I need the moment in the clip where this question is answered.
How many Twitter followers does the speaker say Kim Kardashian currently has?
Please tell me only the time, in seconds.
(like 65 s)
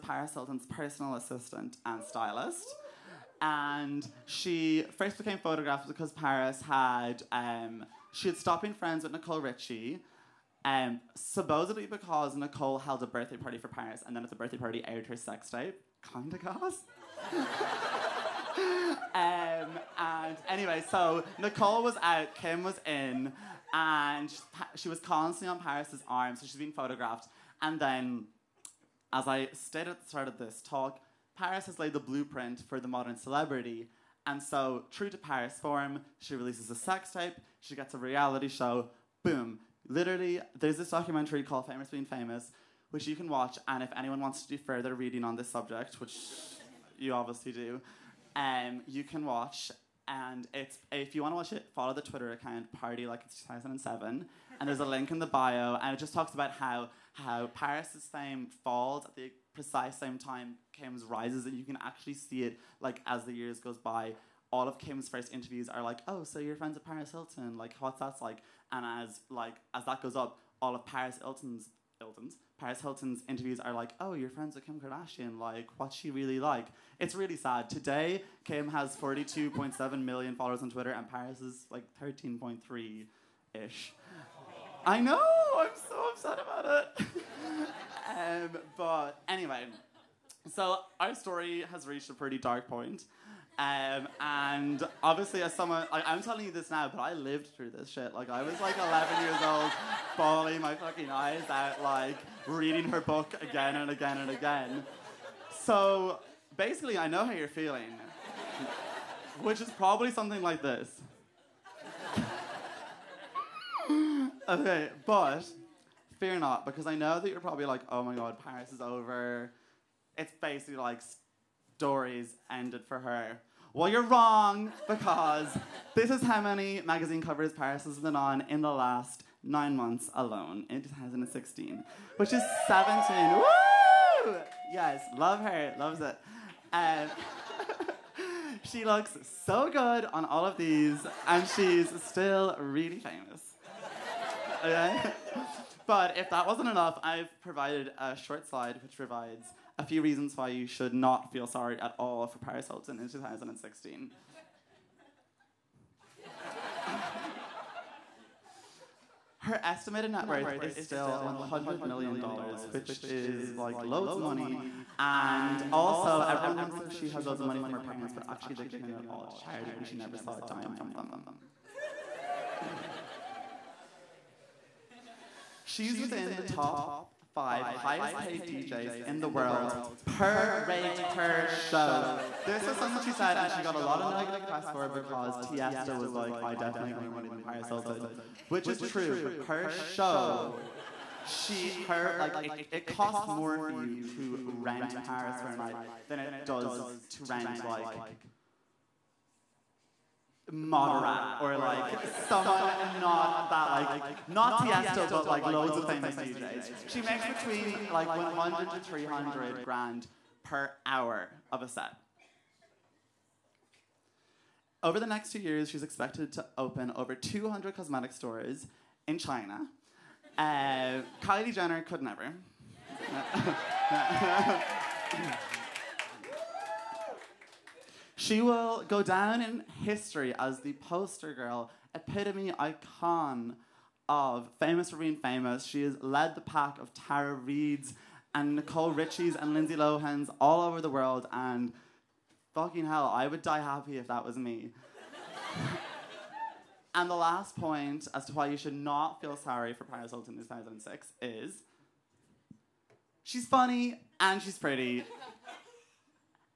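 78 s.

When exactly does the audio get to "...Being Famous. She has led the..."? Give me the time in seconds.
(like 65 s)
234 s.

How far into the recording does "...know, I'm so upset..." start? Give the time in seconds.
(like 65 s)
84 s.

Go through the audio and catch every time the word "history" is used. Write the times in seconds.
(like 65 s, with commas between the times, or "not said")
229 s.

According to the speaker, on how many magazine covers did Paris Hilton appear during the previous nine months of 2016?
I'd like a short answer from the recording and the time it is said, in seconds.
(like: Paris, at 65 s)
17, at 132 s.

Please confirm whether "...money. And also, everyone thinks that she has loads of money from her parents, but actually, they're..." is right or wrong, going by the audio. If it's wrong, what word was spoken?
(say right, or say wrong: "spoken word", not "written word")
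right.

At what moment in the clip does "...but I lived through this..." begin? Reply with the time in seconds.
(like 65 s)
96 s.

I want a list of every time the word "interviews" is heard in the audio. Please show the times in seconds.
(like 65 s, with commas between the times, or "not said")
65 s, 73 s.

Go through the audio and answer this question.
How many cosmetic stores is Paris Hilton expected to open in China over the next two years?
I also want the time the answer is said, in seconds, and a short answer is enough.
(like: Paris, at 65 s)
over 200, at 216 s.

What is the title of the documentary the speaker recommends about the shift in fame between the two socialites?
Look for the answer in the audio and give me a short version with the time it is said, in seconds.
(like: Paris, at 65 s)
Famous Being Famous, at 41 s.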